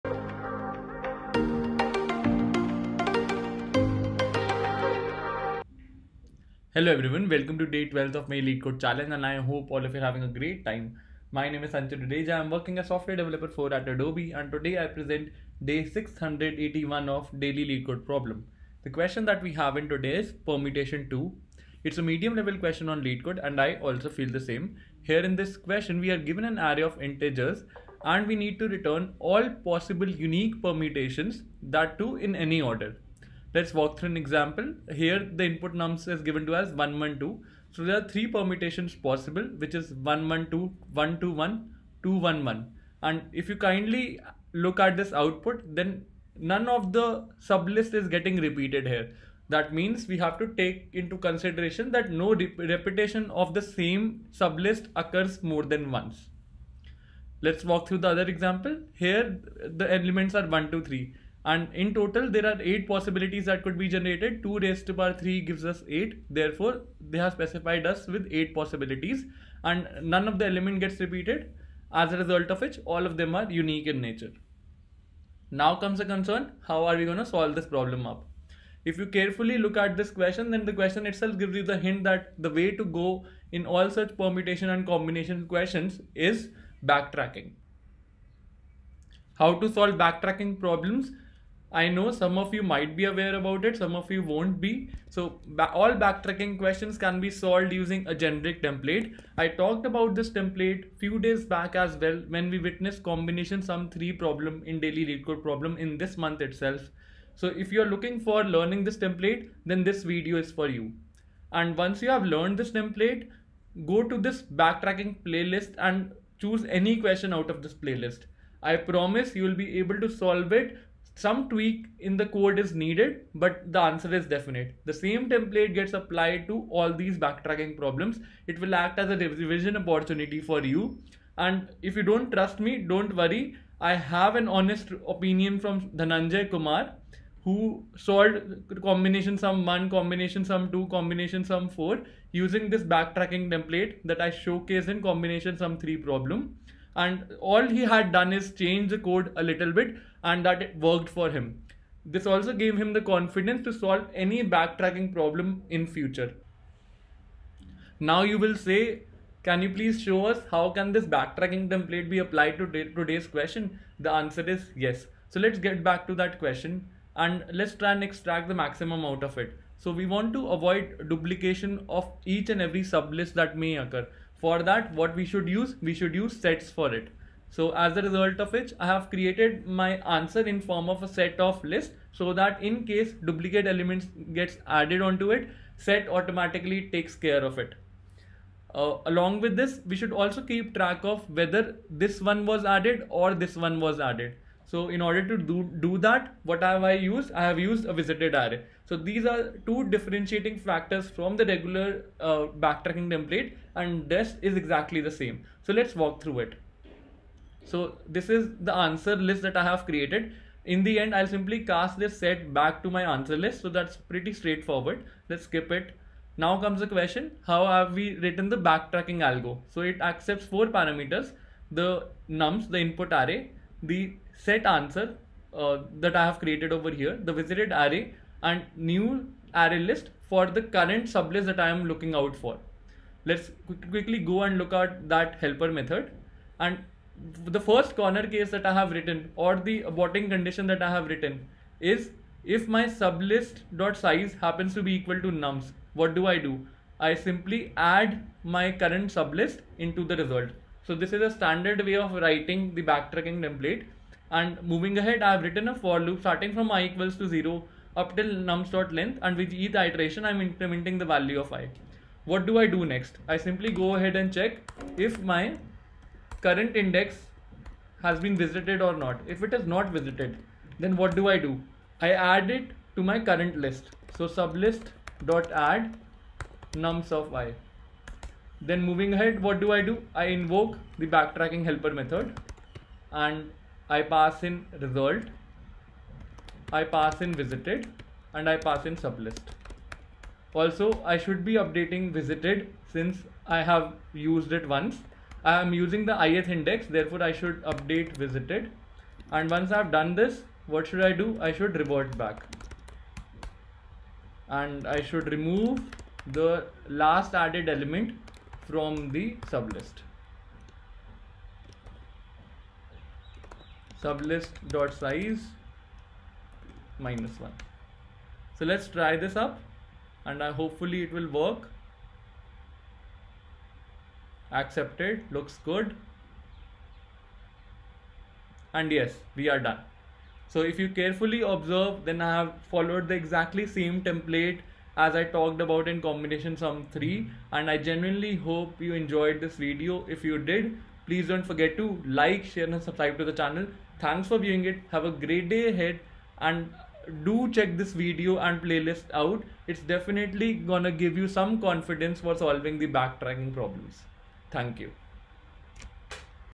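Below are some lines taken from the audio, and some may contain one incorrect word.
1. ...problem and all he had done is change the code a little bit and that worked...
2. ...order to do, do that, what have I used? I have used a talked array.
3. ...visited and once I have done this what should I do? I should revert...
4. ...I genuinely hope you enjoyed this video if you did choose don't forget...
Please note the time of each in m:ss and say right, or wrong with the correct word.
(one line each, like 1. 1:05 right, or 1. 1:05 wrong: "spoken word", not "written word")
1. 2:25 right
2. 3:15 wrong: "visited", not "talked"
3. 4:58 right
4. 5:37 wrong: "please", not "choose".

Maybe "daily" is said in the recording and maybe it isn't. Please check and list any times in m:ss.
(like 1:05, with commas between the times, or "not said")
0:17, 1:44.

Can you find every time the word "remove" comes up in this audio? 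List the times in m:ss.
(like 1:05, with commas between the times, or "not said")
5:05.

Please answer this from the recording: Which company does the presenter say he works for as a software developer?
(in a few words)
Adobe.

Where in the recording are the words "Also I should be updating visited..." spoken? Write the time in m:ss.
4:50.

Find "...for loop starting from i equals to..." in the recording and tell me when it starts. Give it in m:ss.
4:15.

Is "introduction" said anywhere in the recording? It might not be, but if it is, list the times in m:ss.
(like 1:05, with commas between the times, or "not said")
not said.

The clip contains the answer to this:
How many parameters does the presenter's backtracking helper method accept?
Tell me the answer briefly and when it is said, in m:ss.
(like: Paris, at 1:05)
4, at 3:40.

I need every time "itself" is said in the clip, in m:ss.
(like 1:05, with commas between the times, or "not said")
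1:21, 1:46.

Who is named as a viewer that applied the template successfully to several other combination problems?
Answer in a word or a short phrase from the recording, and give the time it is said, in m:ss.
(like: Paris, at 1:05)
Dhananjay Kumar, at 2:16.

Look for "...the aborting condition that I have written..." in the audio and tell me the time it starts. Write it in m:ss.
3:59.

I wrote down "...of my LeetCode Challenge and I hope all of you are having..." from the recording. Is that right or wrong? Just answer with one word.
right.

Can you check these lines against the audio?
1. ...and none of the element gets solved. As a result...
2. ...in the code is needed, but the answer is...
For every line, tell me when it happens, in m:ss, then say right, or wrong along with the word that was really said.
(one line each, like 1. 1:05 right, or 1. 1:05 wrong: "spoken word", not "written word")
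1. 1:09 wrong: "repeated", not "solved"
2. 2:02 right.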